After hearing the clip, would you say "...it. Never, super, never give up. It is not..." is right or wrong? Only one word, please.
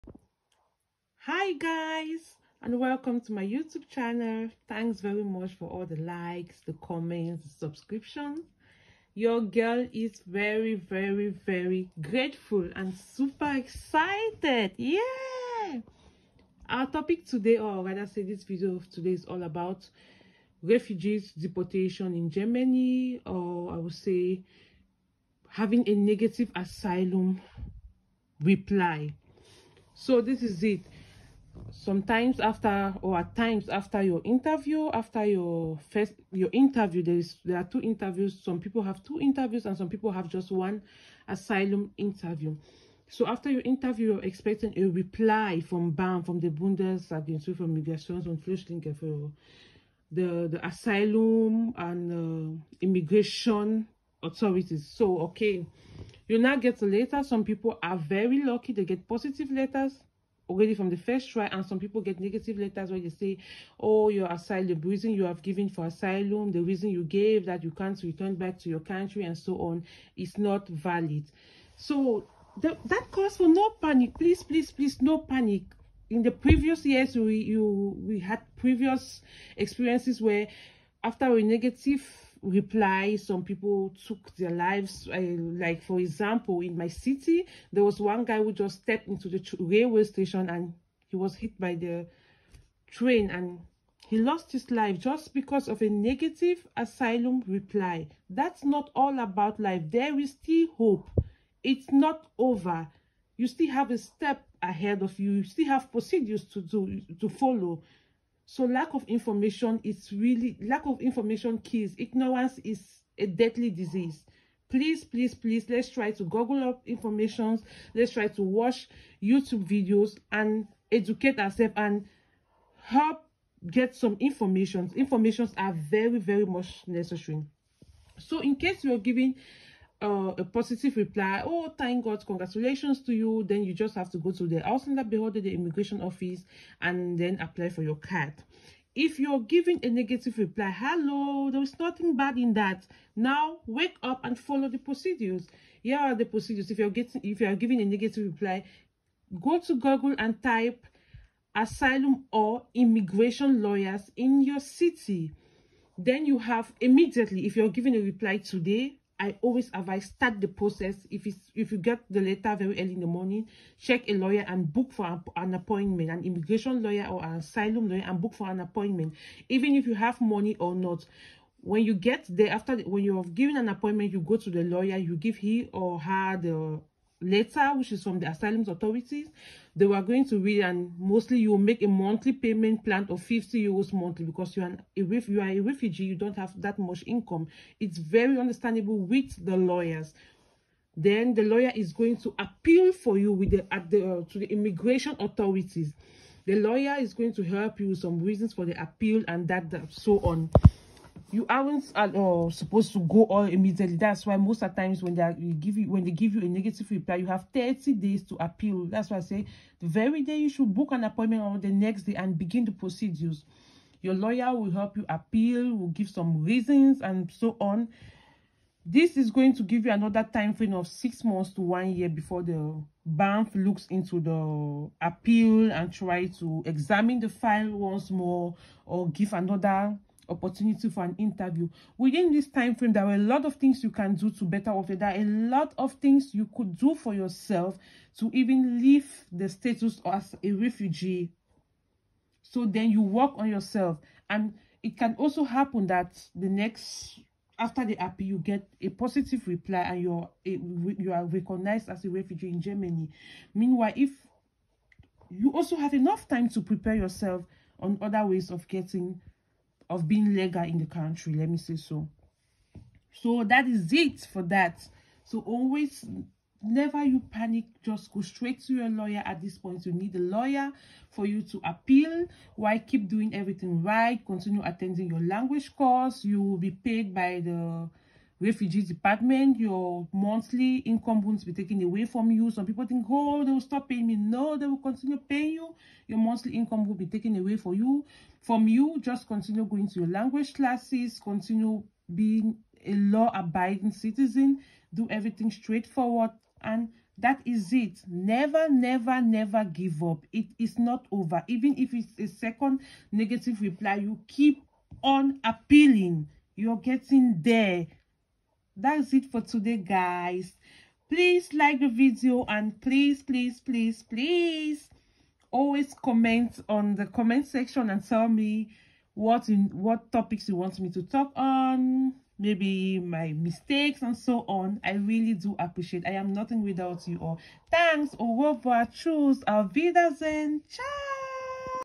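wrong.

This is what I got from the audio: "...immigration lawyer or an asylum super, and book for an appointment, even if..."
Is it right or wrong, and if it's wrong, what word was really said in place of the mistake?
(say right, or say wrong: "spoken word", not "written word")
wrong: "lawyer", not "super".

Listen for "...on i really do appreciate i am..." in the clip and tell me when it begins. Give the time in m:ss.
5:24.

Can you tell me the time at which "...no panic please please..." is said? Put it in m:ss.
1:13.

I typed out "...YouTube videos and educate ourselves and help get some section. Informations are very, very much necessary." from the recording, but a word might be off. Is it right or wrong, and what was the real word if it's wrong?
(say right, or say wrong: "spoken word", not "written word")
wrong: "information", not "section".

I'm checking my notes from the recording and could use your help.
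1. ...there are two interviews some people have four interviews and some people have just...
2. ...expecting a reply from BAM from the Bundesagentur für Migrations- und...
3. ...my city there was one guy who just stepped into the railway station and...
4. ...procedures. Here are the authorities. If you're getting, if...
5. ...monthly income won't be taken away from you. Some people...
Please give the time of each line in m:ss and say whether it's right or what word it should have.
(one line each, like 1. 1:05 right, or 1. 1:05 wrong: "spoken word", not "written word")
1. 0:37 wrong: "two", not "four"
2. 0:44 right
3. 1:26 right
4. 2:24 wrong: "procedures", not "authorities"
5. 4:40 right.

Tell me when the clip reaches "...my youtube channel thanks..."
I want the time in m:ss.
0:03.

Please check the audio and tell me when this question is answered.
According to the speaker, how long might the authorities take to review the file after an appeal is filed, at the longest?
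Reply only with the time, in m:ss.
3:41.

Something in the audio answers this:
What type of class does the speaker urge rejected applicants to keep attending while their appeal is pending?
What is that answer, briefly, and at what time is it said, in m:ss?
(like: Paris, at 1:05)
language course, at 4:35.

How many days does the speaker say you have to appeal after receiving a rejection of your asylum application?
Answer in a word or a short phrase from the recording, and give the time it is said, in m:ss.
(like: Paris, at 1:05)
30 days, at 3:27.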